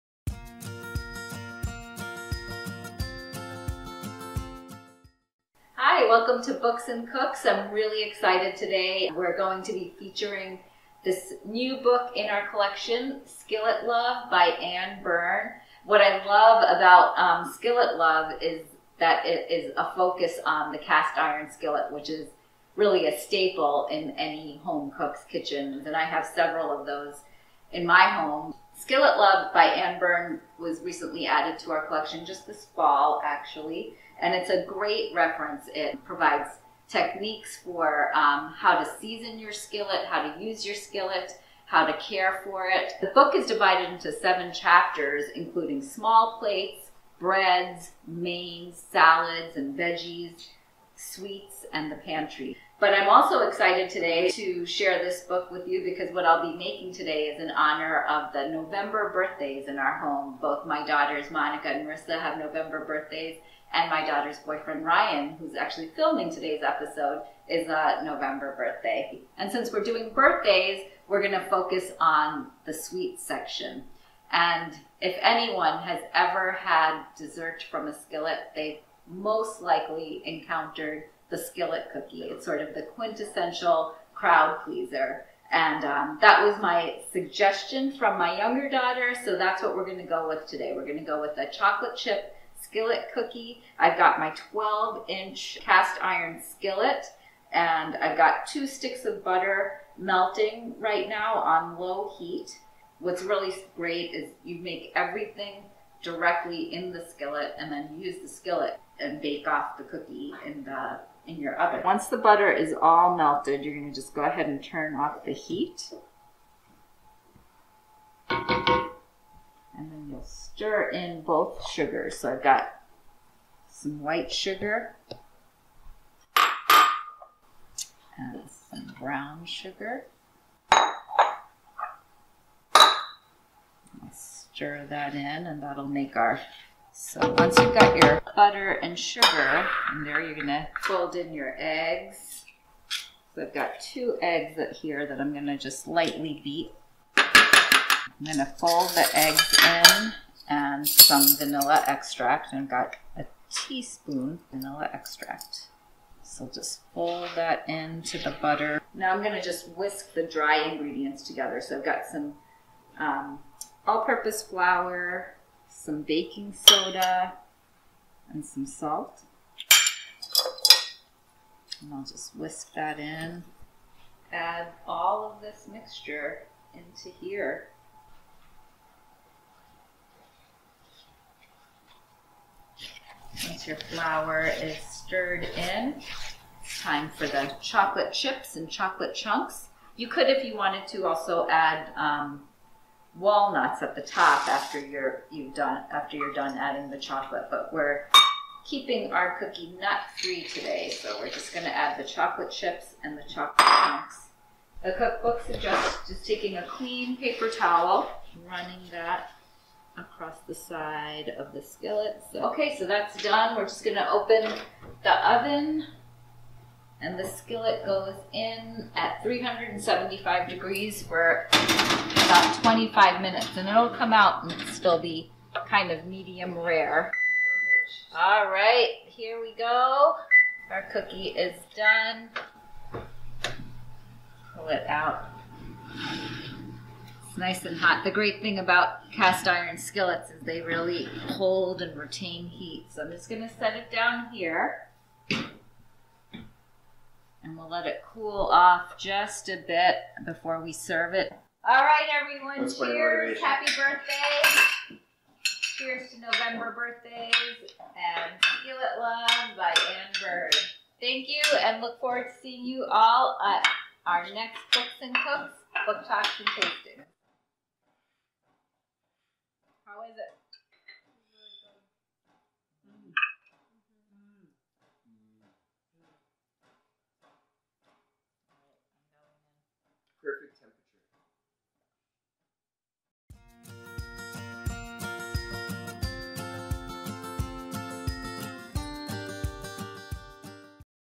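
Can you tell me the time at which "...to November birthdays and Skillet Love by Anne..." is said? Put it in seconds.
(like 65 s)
256 s.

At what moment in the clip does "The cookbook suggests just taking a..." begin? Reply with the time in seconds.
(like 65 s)
204 s.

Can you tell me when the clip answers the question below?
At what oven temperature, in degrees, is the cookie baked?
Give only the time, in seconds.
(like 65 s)
219 s.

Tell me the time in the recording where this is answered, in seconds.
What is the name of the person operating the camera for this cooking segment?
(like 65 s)
64 s.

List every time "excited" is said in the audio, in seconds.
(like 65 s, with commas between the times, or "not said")
8 s, 53 s.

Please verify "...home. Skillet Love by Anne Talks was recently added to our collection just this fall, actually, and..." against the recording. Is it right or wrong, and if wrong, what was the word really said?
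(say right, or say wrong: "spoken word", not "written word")
wrong: "Byrn", not "Talks".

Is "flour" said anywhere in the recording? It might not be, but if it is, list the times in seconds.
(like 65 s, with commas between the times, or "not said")
164 s, 183 s.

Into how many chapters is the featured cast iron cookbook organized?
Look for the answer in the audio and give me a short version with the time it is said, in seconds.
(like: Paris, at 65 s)
7, at 44 s.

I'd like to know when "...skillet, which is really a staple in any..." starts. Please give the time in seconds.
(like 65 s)
21 s.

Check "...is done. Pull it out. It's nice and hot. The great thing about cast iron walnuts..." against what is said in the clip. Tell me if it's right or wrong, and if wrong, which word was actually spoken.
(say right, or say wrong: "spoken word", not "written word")
wrong: "skillets", not "walnuts".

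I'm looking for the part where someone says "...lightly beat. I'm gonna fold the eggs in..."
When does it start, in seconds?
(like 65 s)
145 s.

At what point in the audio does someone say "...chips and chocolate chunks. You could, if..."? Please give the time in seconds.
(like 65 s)
188 s.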